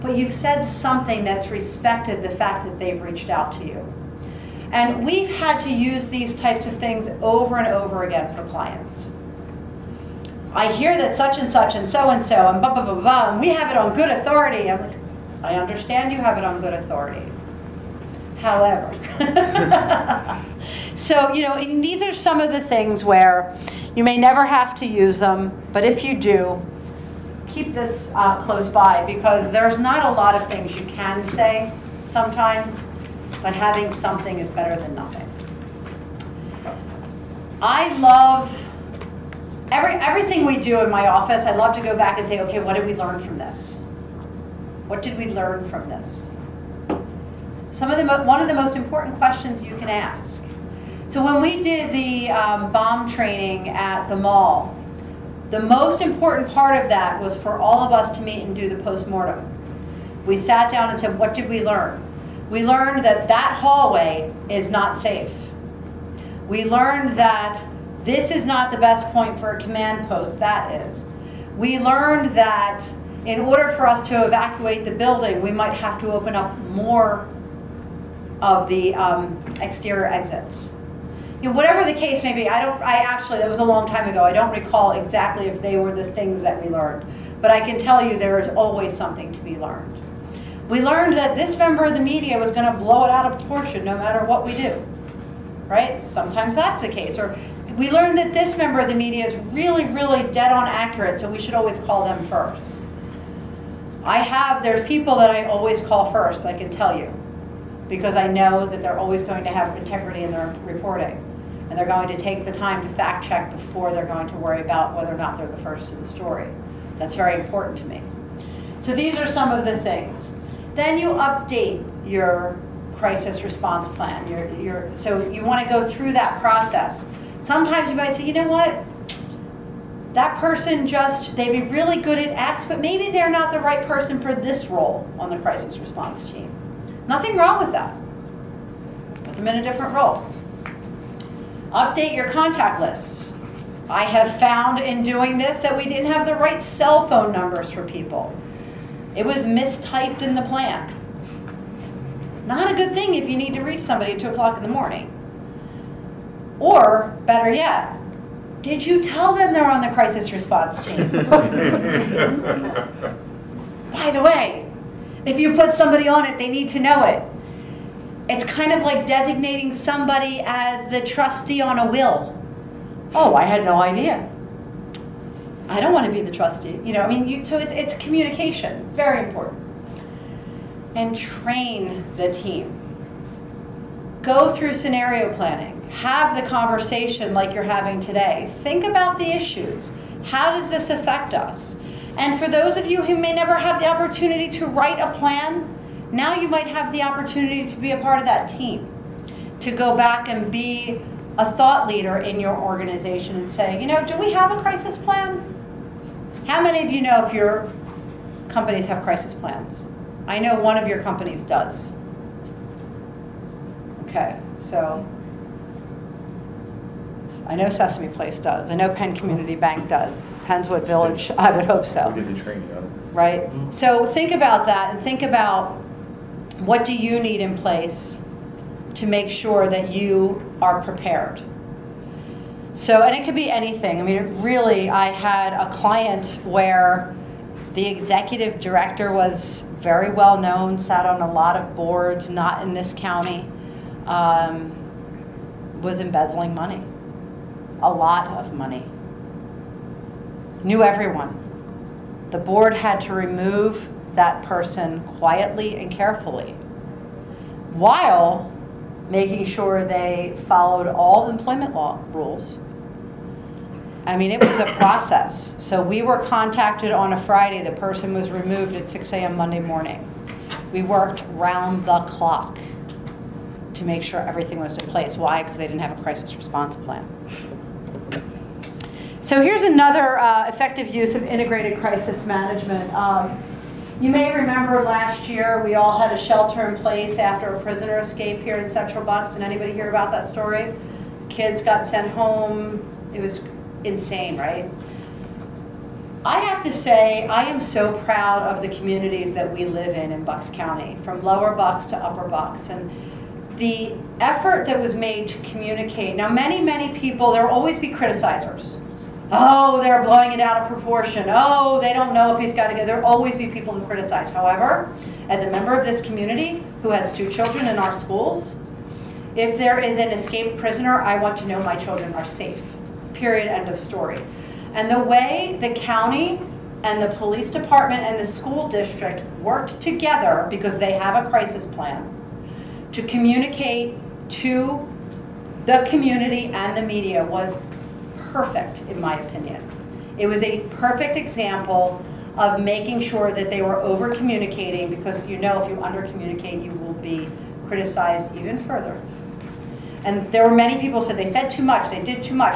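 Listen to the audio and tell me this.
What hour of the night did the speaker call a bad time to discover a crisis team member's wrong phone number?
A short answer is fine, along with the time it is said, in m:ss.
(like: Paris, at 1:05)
2 a.m., at 2:34.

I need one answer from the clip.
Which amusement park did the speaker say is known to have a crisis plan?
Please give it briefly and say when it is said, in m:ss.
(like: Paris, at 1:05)
Sesame Place, at 3:37.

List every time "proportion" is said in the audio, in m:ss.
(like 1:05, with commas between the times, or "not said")
1:33, 5:10.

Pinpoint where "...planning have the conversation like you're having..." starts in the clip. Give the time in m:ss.
3:05.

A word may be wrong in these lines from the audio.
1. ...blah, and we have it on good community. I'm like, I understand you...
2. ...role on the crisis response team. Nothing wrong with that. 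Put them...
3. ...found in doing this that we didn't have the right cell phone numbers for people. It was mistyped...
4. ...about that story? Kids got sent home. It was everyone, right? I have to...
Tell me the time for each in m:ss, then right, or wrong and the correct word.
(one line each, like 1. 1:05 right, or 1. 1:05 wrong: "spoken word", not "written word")
1. 0:12 wrong: "authority", not "community"
2. 2:14 right
3. 2:24 right
4. 4:49 wrong: "insane", not "everyone".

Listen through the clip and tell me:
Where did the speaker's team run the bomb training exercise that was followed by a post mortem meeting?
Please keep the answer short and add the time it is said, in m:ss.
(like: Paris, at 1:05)
the mall, at 0:54.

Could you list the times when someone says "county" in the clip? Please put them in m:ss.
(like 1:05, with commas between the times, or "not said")
4:02, 5:00, 5:25.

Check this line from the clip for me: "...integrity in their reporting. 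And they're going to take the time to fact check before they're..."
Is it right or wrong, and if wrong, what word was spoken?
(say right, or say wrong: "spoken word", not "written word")
right.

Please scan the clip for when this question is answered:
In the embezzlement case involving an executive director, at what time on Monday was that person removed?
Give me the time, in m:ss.
4:28.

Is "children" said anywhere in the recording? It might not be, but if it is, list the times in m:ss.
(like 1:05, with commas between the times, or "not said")
5:17, 5:21.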